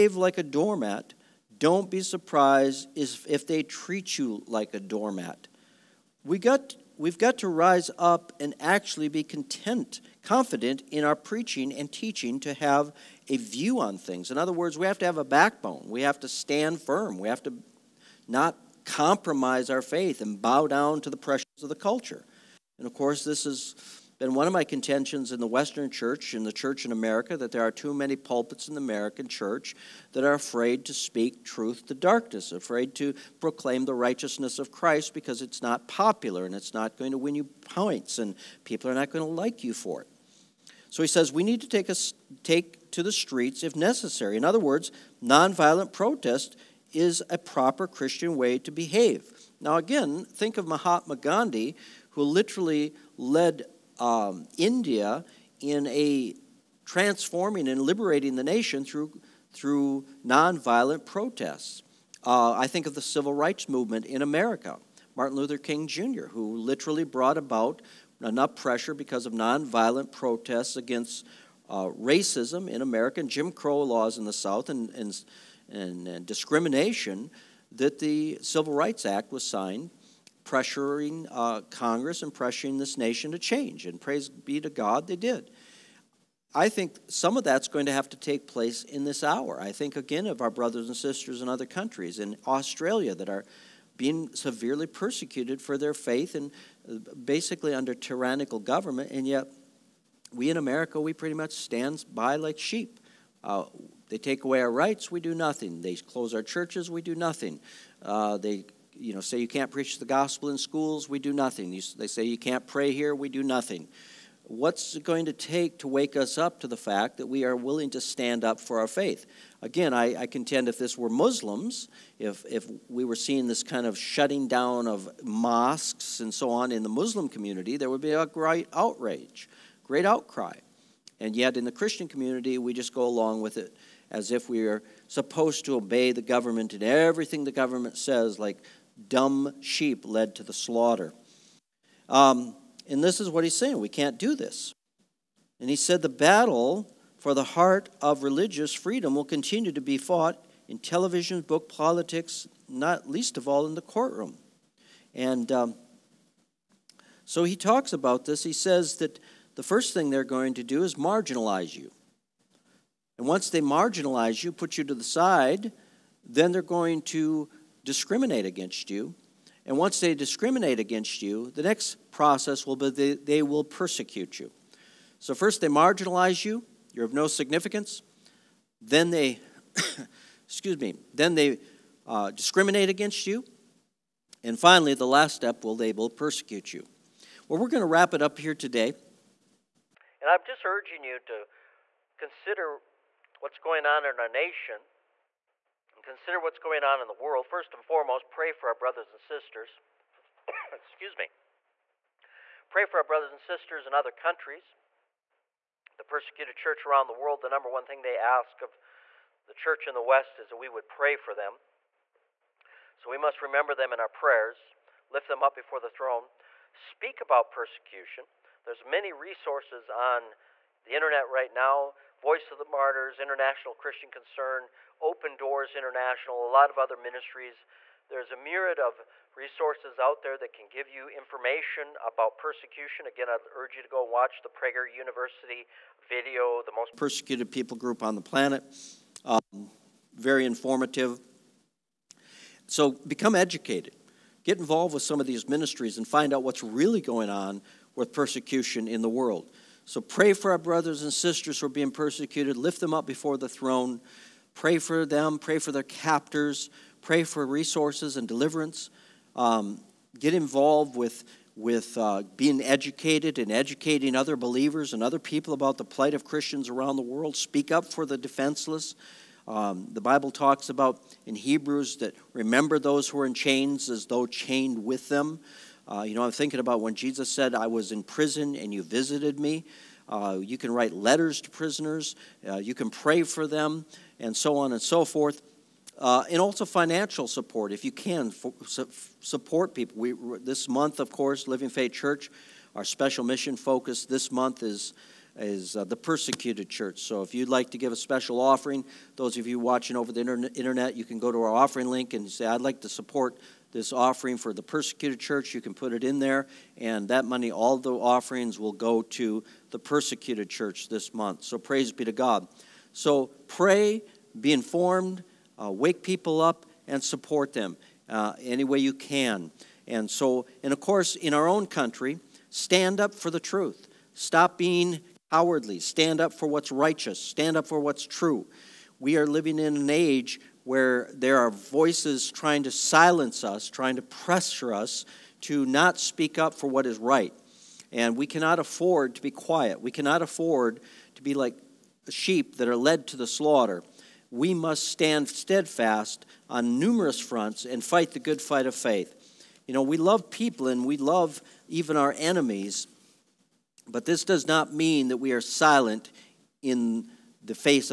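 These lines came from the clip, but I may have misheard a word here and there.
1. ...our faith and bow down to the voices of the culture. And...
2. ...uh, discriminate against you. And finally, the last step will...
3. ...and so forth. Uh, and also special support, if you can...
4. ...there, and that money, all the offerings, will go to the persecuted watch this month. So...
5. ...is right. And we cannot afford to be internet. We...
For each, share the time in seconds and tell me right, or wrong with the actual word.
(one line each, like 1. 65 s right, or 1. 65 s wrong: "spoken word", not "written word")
1. 19 s wrong: "pressures", not "voices"
2. 182 s right
3. 284 s wrong: "financial", not "special"
4. 306 s wrong: "church", not "watch"
5. 336 s wrong: "quiet", not "internet".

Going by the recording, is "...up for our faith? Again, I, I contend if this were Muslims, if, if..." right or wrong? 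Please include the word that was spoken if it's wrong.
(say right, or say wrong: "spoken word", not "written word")
right.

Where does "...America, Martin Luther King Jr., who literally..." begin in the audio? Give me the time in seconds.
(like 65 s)
64 s.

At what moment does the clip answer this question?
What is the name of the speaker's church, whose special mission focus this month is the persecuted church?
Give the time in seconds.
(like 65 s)
291 s.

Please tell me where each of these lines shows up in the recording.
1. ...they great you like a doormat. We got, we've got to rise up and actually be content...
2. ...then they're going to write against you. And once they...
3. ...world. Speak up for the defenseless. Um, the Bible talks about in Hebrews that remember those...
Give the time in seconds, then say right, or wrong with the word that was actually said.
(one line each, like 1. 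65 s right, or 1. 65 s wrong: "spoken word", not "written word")
1. 3 s wrong: "treat", not "great"
2. 166 s wrong: "discriminate", not "write"
3. 267 s right.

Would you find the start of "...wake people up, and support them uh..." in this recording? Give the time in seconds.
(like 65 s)
315 s.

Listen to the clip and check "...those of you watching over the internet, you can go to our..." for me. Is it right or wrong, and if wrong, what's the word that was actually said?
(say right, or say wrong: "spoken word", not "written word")
right.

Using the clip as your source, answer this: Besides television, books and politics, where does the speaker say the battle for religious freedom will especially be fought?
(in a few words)
The courtroom.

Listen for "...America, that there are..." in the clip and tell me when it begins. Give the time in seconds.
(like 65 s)
26 s.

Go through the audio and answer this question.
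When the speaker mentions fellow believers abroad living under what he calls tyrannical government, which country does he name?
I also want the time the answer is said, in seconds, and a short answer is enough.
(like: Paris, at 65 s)
Australia, at 92 s.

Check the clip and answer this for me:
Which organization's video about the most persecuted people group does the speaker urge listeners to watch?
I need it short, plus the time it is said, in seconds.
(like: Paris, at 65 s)
Prager University, at 234 s.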